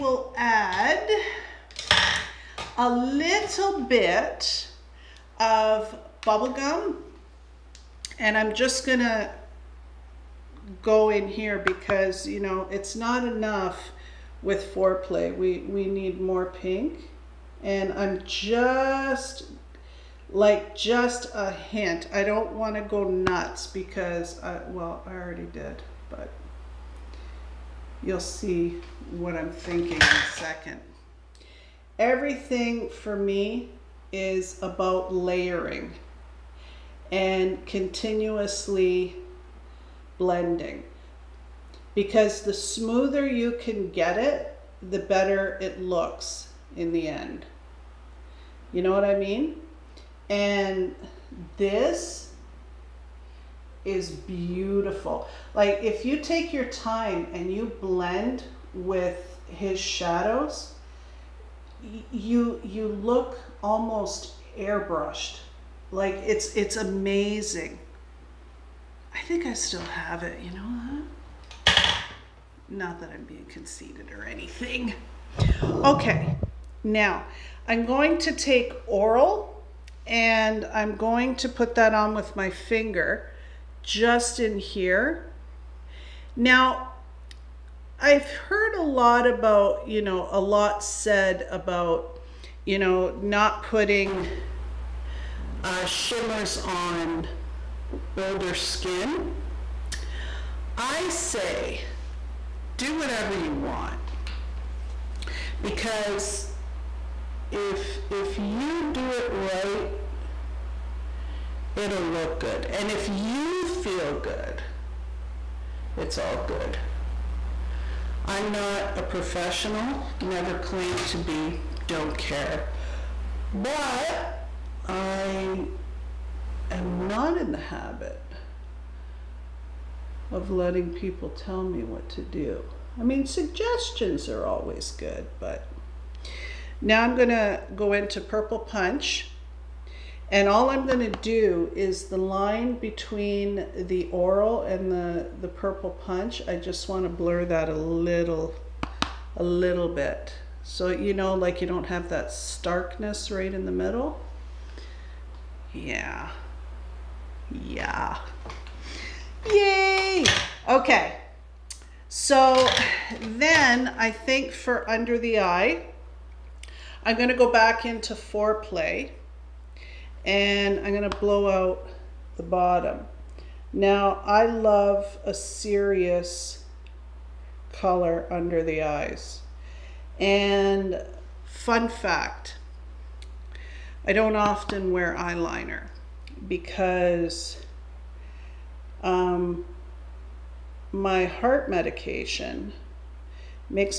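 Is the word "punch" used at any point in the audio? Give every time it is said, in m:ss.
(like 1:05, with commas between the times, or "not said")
2:18, 2:25.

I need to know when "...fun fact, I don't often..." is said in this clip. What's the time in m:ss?
3:01.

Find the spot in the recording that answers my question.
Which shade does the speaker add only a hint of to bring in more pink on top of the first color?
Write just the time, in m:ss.
0:06.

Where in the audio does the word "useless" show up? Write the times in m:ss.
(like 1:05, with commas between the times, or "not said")
not said.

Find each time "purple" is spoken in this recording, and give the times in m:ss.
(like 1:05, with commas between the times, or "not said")
2:18, 2:25.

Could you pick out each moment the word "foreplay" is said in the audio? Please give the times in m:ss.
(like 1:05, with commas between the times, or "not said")
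0:14, 2:48.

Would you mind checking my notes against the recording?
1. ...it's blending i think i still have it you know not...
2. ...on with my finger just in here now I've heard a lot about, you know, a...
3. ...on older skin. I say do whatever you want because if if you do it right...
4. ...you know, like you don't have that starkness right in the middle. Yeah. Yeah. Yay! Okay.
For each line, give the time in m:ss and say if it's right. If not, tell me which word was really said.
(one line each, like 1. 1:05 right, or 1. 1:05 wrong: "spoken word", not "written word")
1. 1:06 wrong: "amazing", not "blending"
2. 1:21 right
3. 1:36 right
4. 2:30 right.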